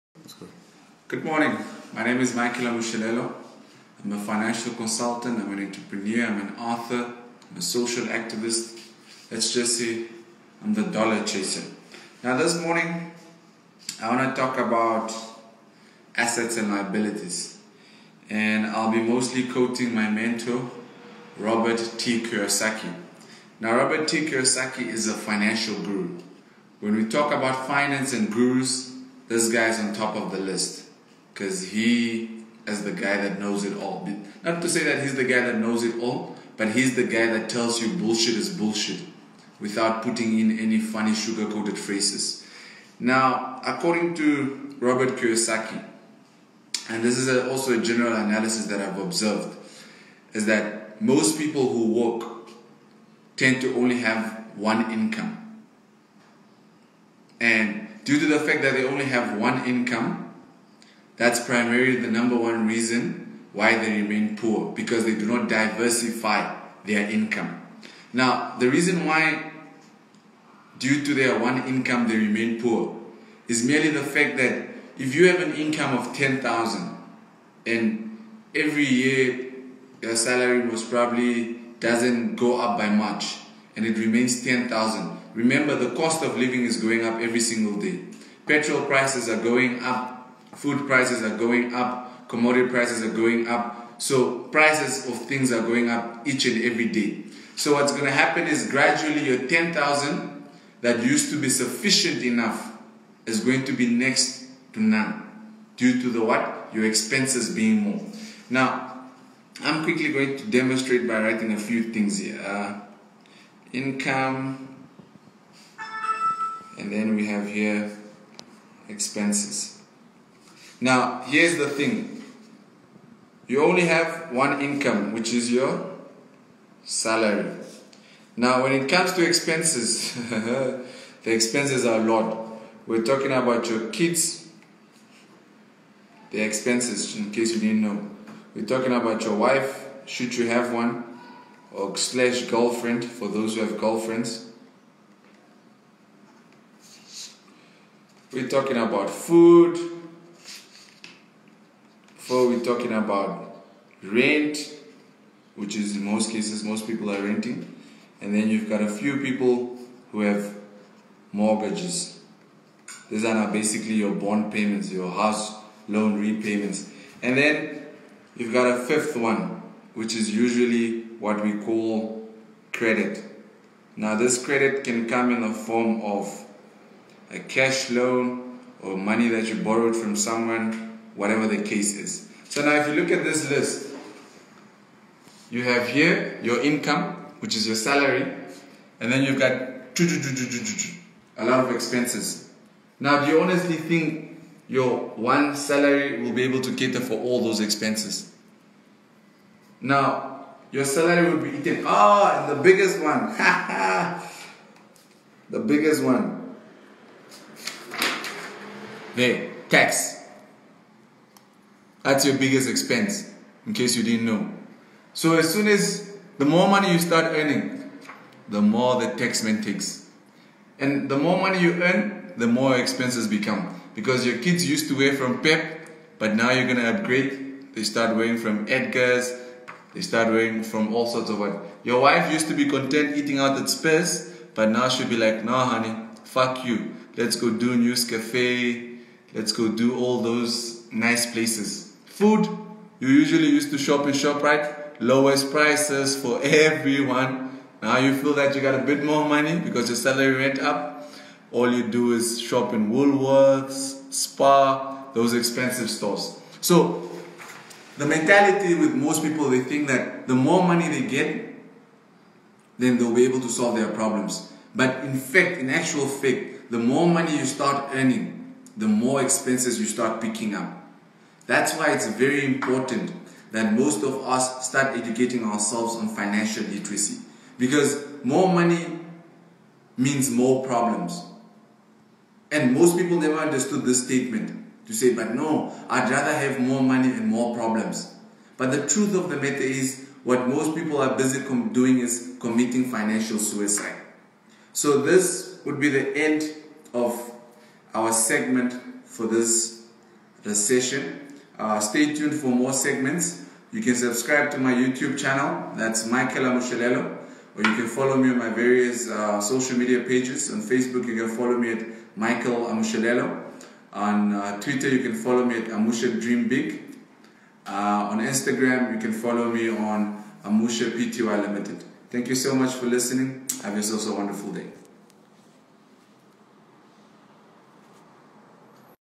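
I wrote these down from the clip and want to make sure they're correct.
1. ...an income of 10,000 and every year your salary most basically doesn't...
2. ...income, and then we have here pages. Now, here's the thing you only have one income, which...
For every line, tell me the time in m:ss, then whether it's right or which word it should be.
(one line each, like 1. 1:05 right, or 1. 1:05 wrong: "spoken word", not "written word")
1. 1:15 wrong: "probably", not "basically"
2. 1:53 wrong: "expenses", not "pages".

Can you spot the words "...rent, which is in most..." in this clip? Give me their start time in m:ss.
2:34.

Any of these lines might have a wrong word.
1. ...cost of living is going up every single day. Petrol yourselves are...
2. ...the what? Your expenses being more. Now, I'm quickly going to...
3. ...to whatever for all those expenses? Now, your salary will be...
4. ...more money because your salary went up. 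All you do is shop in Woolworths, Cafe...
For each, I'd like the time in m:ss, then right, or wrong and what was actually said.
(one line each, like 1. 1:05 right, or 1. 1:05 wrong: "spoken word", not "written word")
1. 1:25 wrong: "prices", not "yourselves"
2. 1:46 right
3. 3:16 wrong: "cater", not "whatever"
4. 4:09 wrong: "Spa", not "Cafe".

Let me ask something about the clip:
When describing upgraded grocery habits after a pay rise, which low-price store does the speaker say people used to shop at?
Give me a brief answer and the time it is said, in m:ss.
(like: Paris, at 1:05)
ShopRite, at 4:04.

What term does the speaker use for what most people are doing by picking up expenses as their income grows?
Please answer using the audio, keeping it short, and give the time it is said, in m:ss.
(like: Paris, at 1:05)
Financial suicide, at 4:52.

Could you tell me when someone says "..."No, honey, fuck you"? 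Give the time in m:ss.
3:55.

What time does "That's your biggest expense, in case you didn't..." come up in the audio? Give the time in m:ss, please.
3:32.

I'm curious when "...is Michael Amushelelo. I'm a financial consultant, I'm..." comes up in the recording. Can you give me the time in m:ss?
0:02.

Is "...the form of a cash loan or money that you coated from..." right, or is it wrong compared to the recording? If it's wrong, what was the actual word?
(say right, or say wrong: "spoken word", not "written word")
wrong: "borrowed", not "coated".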